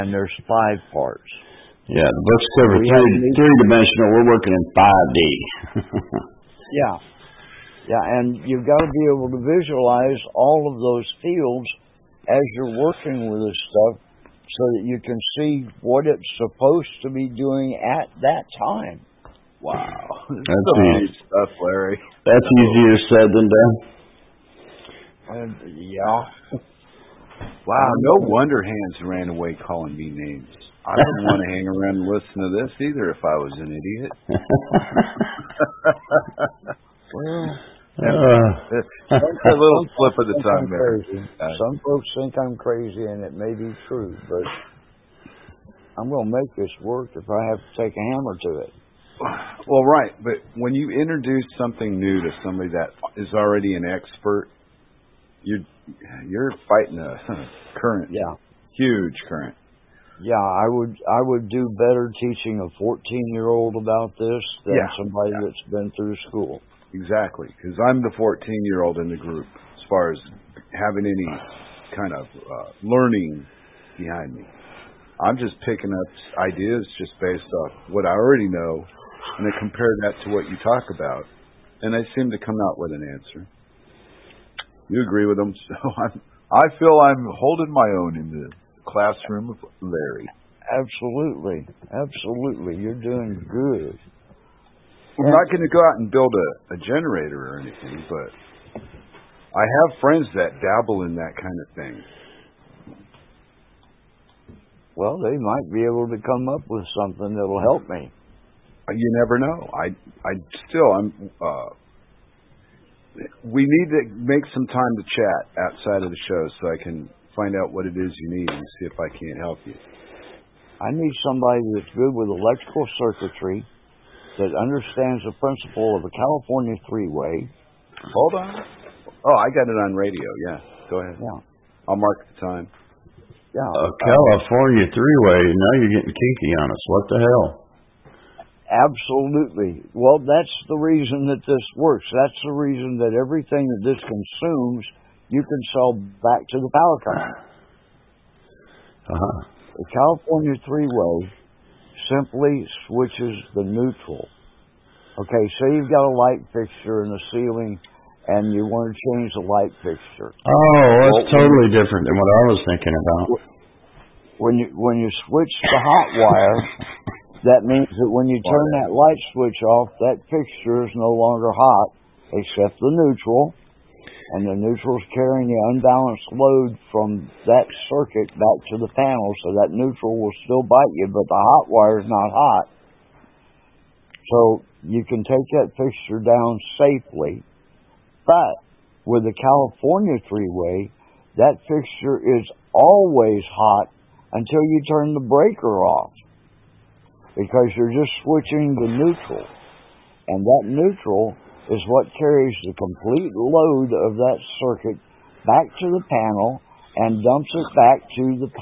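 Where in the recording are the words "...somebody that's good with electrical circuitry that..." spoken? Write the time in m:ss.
2:01.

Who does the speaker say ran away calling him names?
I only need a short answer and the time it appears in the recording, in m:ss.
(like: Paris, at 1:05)
Hans, at 0:28.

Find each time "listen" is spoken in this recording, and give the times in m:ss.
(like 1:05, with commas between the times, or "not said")
0:32.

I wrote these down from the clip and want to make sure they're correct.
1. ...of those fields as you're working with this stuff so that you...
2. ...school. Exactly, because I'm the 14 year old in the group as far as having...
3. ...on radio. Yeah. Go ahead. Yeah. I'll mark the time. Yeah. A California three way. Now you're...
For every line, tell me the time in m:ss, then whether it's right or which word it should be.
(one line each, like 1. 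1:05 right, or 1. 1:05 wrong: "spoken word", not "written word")
1. 0:10 right
2. 1:06 right
3. 2:09 right.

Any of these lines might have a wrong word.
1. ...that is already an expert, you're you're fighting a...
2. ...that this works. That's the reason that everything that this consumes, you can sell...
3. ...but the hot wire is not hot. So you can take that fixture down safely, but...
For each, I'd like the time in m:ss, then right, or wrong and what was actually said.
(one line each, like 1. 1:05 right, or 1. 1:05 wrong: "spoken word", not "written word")
1. 0:52 right
2. 2:21 right
3. 3:01 right.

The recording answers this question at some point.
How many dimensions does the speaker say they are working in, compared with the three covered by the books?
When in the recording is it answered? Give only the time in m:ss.
0:04.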